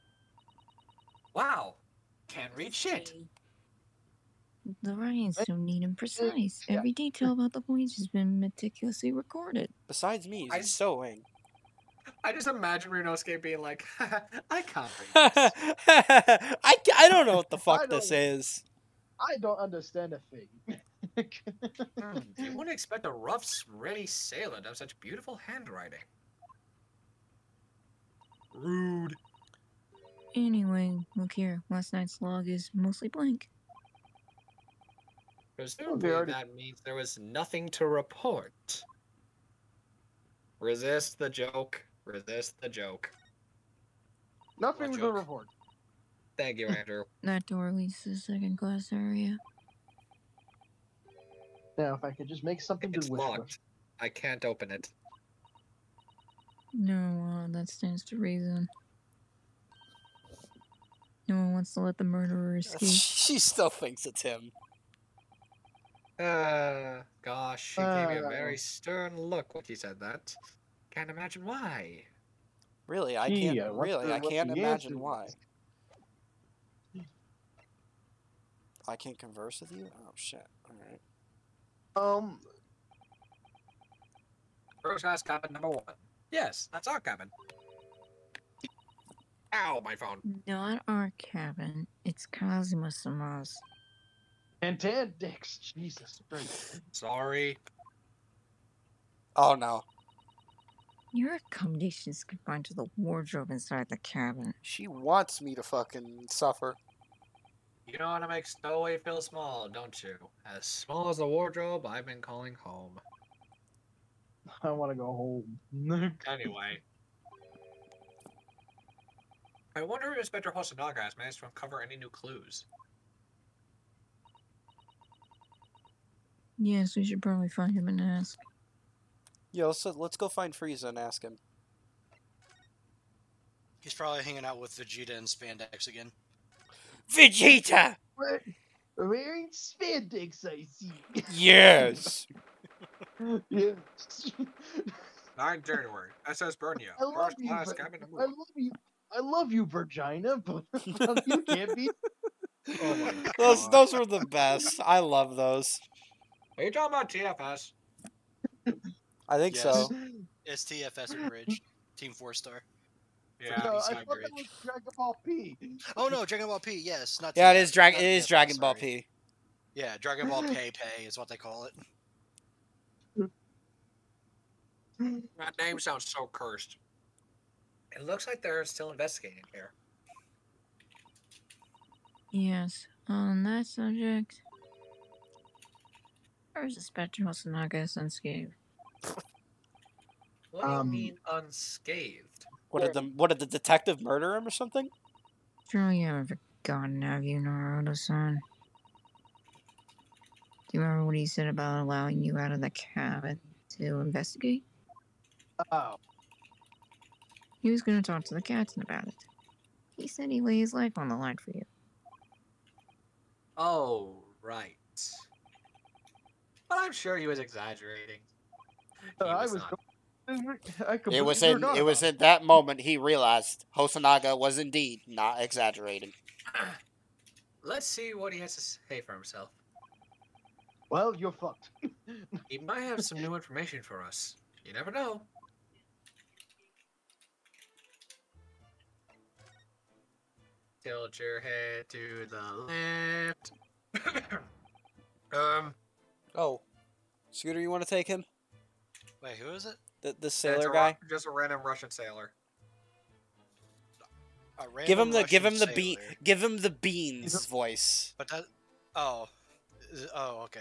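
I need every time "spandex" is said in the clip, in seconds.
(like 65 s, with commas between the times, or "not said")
135 s, 139 s.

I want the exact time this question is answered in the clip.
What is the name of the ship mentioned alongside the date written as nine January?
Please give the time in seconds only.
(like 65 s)
146 s.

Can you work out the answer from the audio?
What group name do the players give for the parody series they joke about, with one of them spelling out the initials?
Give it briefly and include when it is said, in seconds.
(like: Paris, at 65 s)
Team Four Star, at 161 s.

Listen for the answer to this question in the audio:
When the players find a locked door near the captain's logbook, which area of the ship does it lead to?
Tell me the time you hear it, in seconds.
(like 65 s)
48 s.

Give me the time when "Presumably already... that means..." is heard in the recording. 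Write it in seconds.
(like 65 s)
35 s.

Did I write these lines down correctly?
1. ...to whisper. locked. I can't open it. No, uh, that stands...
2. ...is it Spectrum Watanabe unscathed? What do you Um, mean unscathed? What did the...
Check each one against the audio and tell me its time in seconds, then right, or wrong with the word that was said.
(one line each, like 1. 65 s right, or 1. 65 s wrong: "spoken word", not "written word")
1. 53 s right
2. 186 s right.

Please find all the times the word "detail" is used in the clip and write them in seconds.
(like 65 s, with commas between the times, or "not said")
6 s.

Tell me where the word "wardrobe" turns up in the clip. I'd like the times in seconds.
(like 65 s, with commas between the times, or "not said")
102 s, 111 s.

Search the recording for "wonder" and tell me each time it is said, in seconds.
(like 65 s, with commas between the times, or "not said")
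119 s.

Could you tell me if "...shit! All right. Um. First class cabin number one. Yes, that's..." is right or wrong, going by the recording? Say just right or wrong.
right.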